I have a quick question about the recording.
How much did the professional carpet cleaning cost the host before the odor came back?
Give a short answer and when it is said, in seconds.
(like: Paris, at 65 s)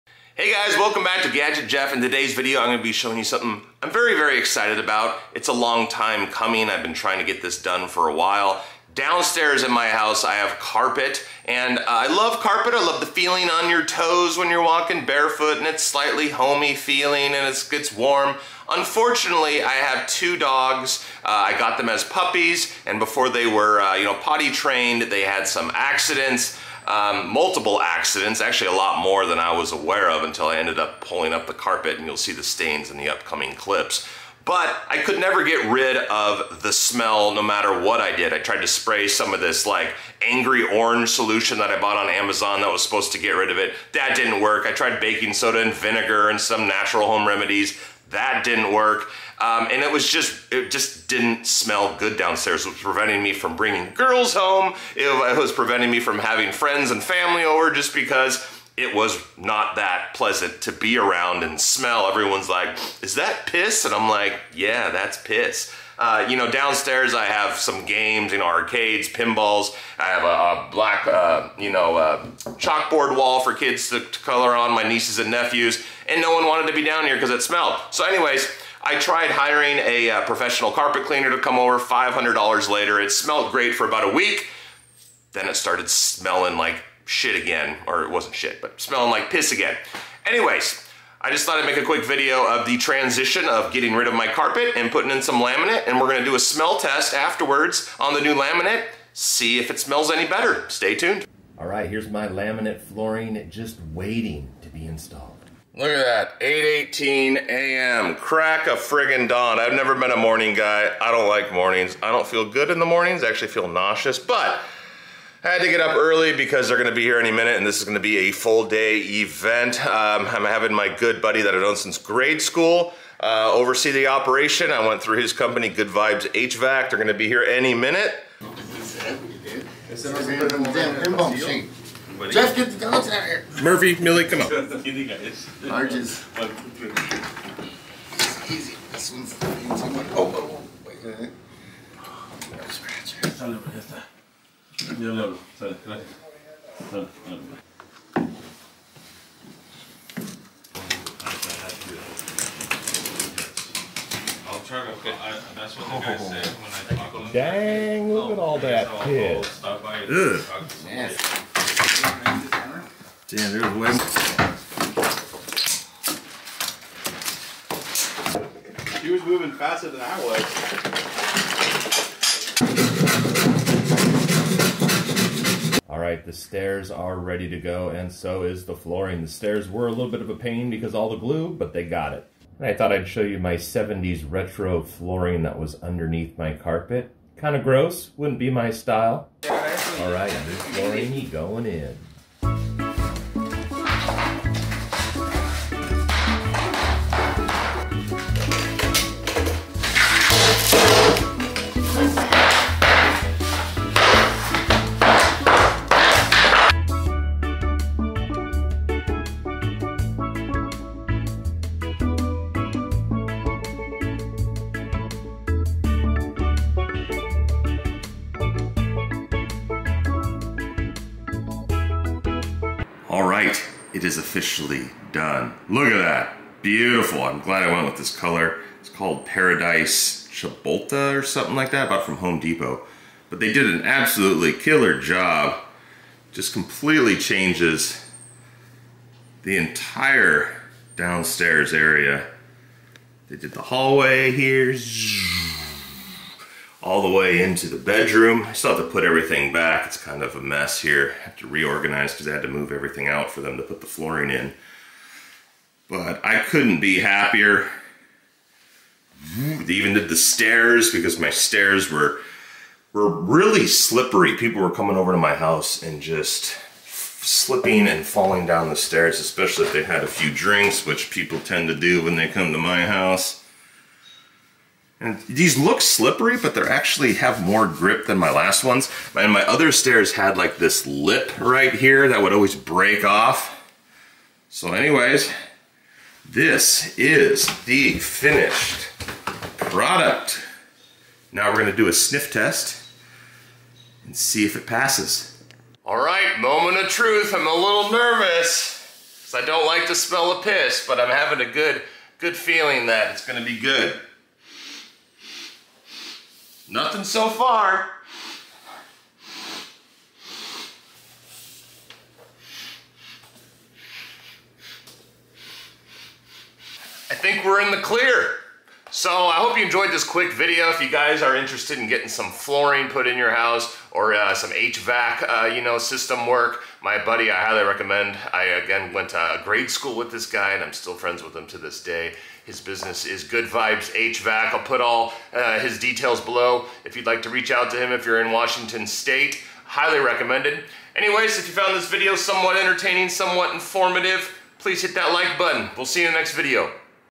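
$500, at 81 s.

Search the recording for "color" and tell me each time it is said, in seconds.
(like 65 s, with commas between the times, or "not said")
74 s, 228 s.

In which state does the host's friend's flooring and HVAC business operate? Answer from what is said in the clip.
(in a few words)
Washington State.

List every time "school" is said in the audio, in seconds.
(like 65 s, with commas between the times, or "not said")
122 s, 329 s.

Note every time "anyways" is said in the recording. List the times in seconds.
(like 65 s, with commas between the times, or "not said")
78 s, 90 s, 284 s, 340 s.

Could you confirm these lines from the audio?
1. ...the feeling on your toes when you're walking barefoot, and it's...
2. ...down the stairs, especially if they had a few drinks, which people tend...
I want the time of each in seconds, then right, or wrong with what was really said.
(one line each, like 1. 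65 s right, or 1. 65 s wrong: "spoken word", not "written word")
1. 13 s right
2. 268 s right.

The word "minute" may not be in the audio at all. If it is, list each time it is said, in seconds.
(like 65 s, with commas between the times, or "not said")
117 s, 127 s.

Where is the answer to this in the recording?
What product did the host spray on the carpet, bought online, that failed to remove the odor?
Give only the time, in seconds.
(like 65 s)
40 s.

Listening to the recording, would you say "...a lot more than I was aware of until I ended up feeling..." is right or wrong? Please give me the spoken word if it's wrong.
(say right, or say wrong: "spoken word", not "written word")
wrong: "pulling", not "feeling".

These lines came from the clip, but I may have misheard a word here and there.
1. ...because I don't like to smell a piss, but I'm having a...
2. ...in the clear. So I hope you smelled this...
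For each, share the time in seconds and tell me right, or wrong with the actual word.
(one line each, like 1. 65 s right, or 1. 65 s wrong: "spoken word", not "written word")
1. 299 s right
2. 317 s wrong: "enjoyed", not "smelled".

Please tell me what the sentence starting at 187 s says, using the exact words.
Kind of gross, wouldn't be my style.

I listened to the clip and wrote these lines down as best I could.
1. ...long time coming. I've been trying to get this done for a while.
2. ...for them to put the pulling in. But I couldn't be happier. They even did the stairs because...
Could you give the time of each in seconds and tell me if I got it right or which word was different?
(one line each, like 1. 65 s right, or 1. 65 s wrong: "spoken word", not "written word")
1. 5 s right
2. 253 s wrong: "flooring", not "pulling".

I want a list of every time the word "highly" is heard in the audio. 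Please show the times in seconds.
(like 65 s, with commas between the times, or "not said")
327 s, 339 s.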